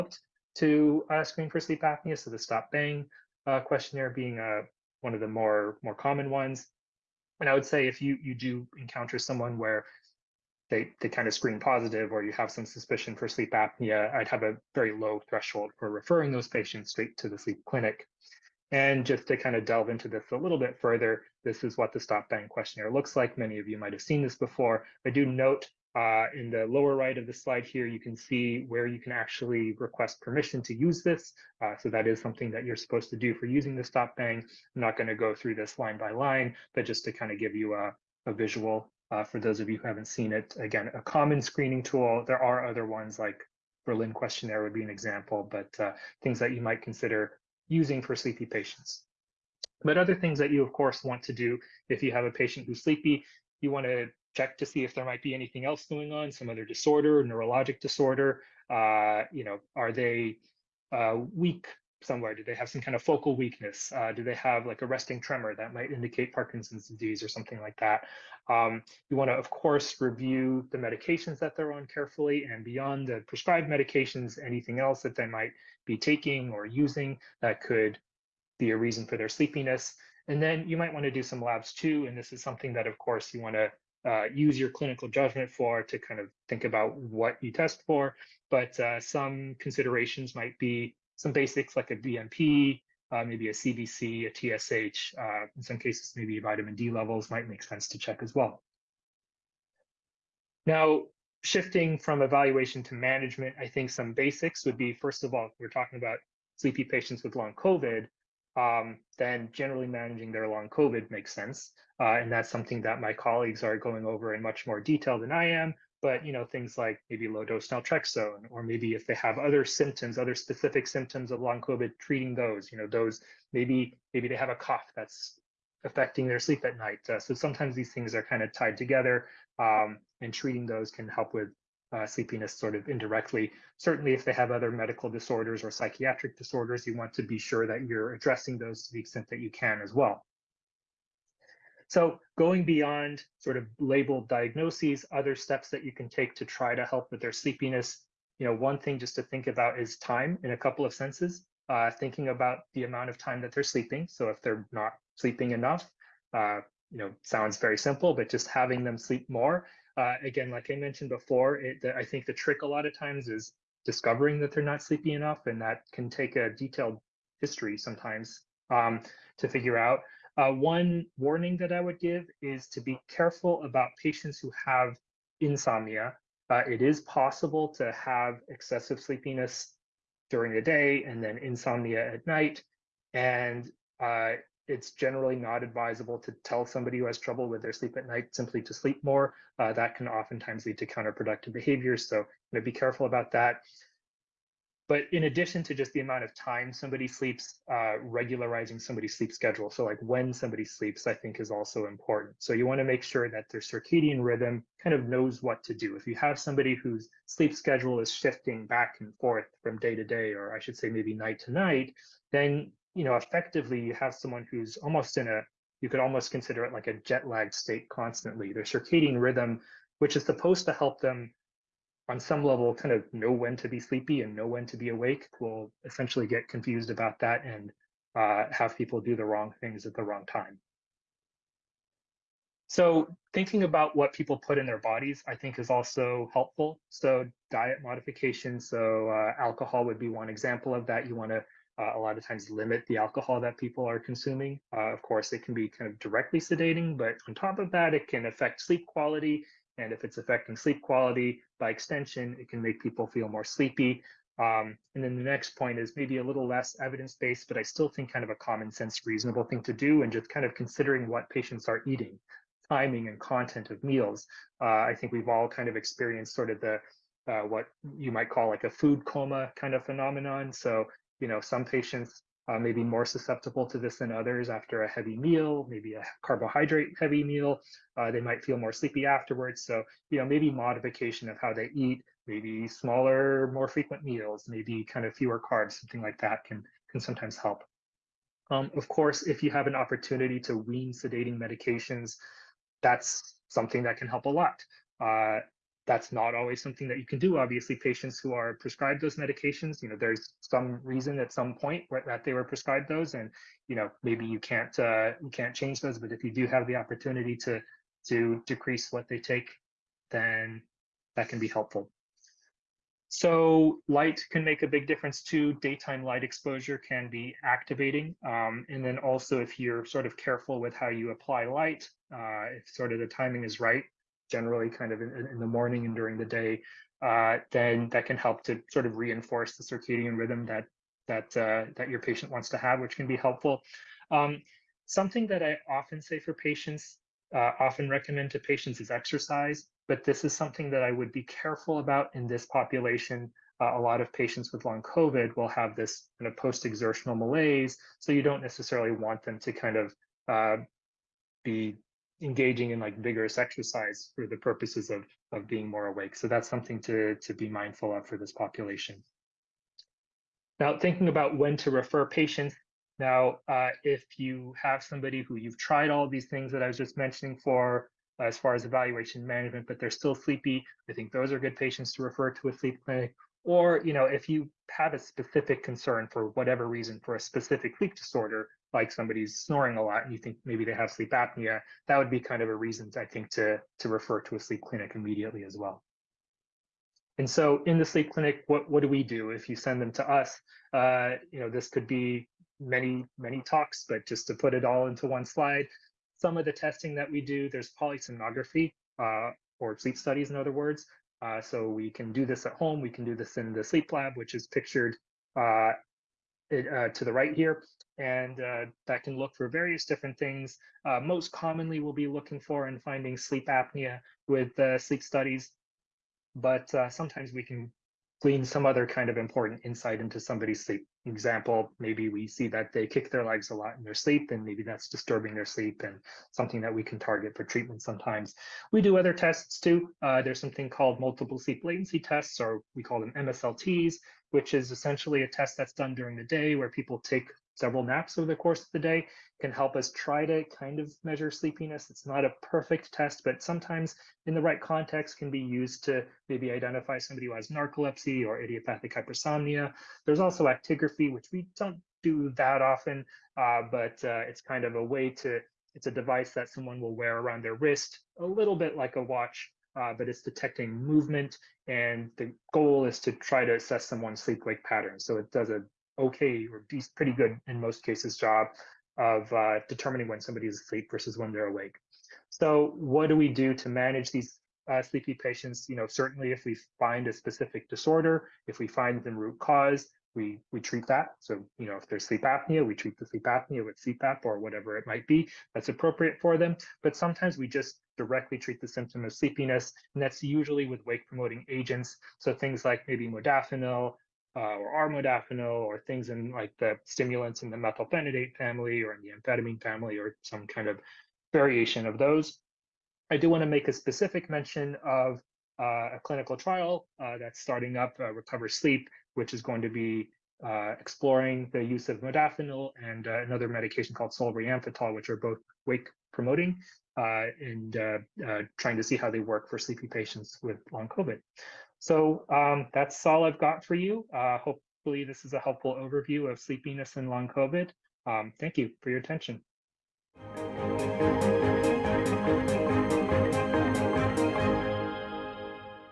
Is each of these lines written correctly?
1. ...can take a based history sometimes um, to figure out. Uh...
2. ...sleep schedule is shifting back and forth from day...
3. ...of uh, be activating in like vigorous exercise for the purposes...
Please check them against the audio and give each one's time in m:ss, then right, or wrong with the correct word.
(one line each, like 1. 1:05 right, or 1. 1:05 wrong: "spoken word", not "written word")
1. 2:45 wrong: "detailed", not "based"
2. 3:27 right
3. 5:49 wrong: "engaging", not "activating".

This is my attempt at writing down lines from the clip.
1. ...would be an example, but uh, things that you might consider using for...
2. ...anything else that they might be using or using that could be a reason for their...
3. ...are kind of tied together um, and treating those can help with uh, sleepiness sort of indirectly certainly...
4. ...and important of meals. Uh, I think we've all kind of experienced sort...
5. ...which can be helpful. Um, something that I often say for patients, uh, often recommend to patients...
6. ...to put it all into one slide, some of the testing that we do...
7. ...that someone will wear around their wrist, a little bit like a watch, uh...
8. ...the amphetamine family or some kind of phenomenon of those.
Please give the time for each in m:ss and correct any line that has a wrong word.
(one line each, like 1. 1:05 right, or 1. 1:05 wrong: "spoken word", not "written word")
1. 0:44 right
2. 1:14 wrong: "taking", not "using"
3. 2:08 right
4. 4:23 wrong: "content", not "important"
5. 5:32 right
6. 6:34 right
7. 7:36 right
8. 8:19 wrong: "variation", not "phenomenon".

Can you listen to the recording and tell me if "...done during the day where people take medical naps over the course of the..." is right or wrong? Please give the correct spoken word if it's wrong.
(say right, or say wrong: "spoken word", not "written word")
wrong: "several", not "medical".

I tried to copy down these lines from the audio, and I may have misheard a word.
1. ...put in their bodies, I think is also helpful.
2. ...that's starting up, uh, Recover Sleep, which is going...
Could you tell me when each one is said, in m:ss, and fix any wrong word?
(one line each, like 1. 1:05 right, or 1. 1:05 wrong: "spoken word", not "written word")
1. 3:54 right
2. 8:27 right.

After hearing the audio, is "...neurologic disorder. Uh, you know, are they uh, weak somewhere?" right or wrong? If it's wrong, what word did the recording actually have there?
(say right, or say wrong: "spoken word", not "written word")
right.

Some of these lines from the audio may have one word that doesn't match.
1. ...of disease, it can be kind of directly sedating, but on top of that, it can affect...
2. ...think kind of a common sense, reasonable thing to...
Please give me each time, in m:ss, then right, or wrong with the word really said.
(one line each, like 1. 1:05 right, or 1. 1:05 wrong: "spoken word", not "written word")
1. 4:04 wrong: "course", not "disease"
2. 4:17 right.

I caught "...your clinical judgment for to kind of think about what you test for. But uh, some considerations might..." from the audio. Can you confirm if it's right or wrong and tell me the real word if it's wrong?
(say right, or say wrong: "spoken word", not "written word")
right.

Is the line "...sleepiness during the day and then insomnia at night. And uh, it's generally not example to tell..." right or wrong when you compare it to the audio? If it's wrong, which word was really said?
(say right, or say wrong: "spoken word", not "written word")
wrong: "advisable", not "example".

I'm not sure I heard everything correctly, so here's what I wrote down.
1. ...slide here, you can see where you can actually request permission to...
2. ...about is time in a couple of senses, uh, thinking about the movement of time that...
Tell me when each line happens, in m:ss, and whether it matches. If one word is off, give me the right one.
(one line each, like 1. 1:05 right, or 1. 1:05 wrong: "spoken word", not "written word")
1. 0:27 right
2. 2:29 wrong: "amount", not "movement".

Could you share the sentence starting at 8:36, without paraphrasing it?
Uh, and uh, uh, trying to see how they work for sleepy patients with long COVID.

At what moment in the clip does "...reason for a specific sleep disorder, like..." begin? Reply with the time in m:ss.
6:16.